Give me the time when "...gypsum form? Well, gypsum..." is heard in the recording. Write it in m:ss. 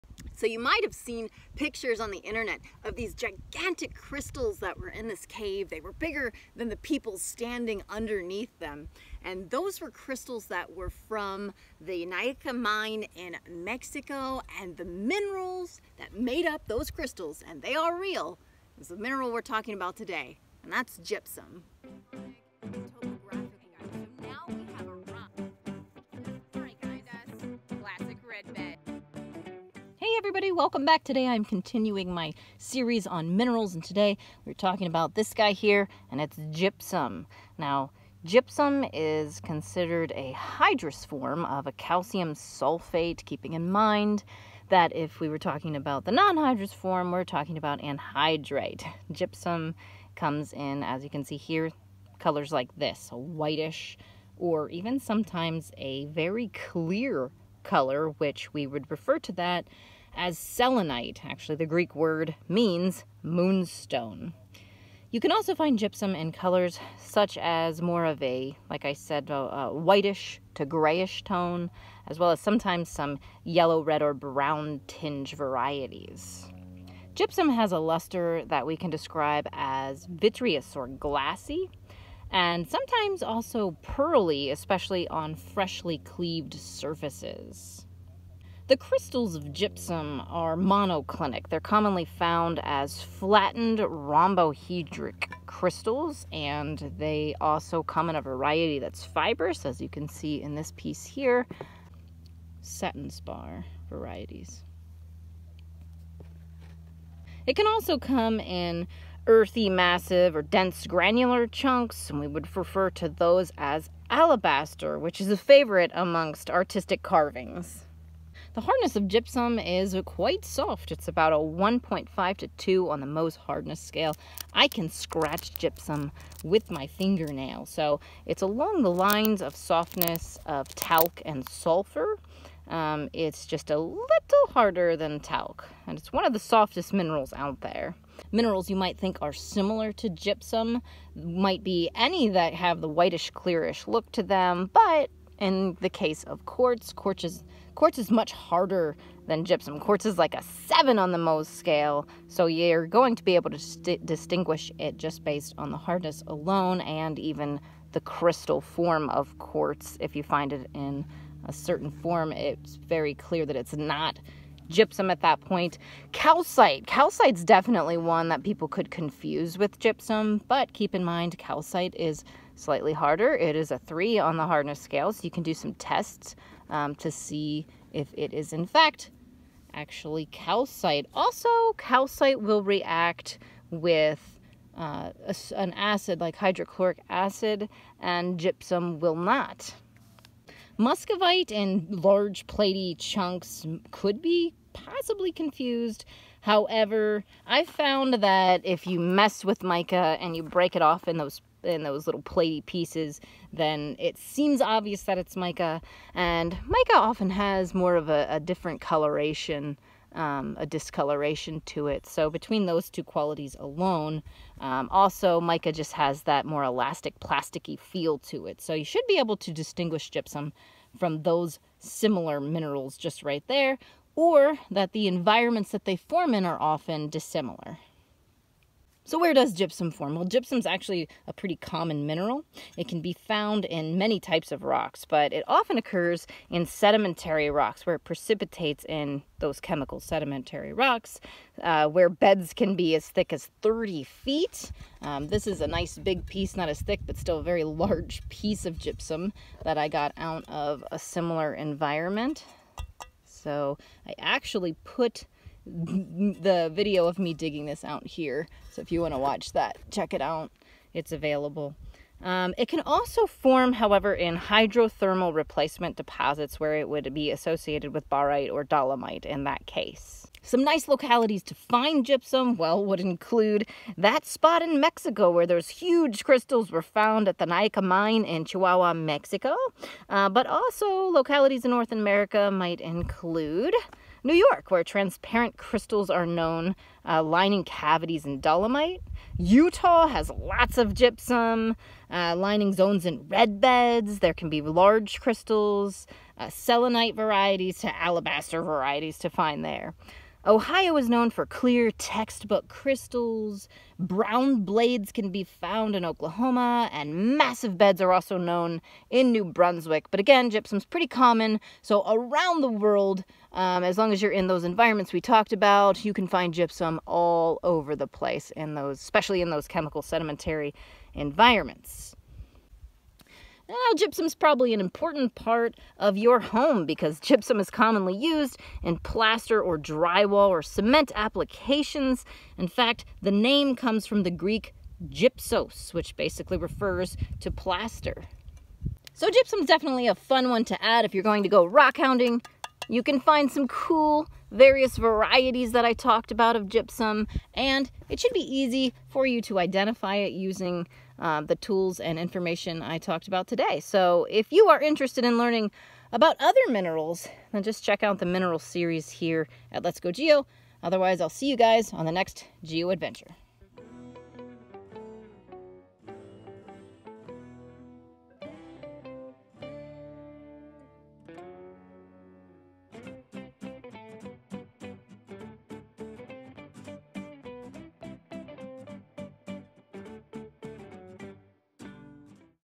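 3:49.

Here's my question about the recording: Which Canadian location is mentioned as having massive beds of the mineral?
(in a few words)
New Brunswick.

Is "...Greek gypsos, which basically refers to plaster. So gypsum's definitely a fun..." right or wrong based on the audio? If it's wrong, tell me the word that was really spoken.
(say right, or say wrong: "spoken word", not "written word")
right.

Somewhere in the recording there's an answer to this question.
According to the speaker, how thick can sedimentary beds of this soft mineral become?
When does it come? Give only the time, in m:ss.
4:03.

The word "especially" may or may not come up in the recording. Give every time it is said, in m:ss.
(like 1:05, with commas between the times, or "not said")
1:24, 5:18.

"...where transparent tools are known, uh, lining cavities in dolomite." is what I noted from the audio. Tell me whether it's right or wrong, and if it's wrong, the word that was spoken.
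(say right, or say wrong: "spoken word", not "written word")
wrong: "crystals", not "tools".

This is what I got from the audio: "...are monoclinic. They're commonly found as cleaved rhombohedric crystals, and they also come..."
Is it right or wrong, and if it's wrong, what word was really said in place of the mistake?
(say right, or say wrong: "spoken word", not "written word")
wrong: "flattened", not "cleaved".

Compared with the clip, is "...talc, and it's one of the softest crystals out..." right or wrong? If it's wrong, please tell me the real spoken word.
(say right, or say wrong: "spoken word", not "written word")
wrong: "minerals", not "crystals".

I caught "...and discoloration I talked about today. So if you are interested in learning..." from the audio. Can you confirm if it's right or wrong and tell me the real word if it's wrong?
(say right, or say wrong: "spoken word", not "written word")
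wrong: "information", not "discoloration".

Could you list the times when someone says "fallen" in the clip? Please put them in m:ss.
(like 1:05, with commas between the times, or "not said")
not said.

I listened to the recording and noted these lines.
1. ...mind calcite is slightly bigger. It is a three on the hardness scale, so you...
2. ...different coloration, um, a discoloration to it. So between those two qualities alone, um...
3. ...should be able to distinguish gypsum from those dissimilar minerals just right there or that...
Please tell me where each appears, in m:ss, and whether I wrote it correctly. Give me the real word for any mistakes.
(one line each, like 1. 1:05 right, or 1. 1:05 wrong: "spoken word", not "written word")
1. 2:51 wrong: "harder", not "bigger"
2. 3:28 right
3. 3:38 wrong: "similar", not "dissimilar".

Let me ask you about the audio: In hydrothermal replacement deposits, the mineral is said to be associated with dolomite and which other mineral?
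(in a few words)
barite.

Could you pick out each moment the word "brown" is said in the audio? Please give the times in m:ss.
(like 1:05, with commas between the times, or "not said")
1:14, 5:03.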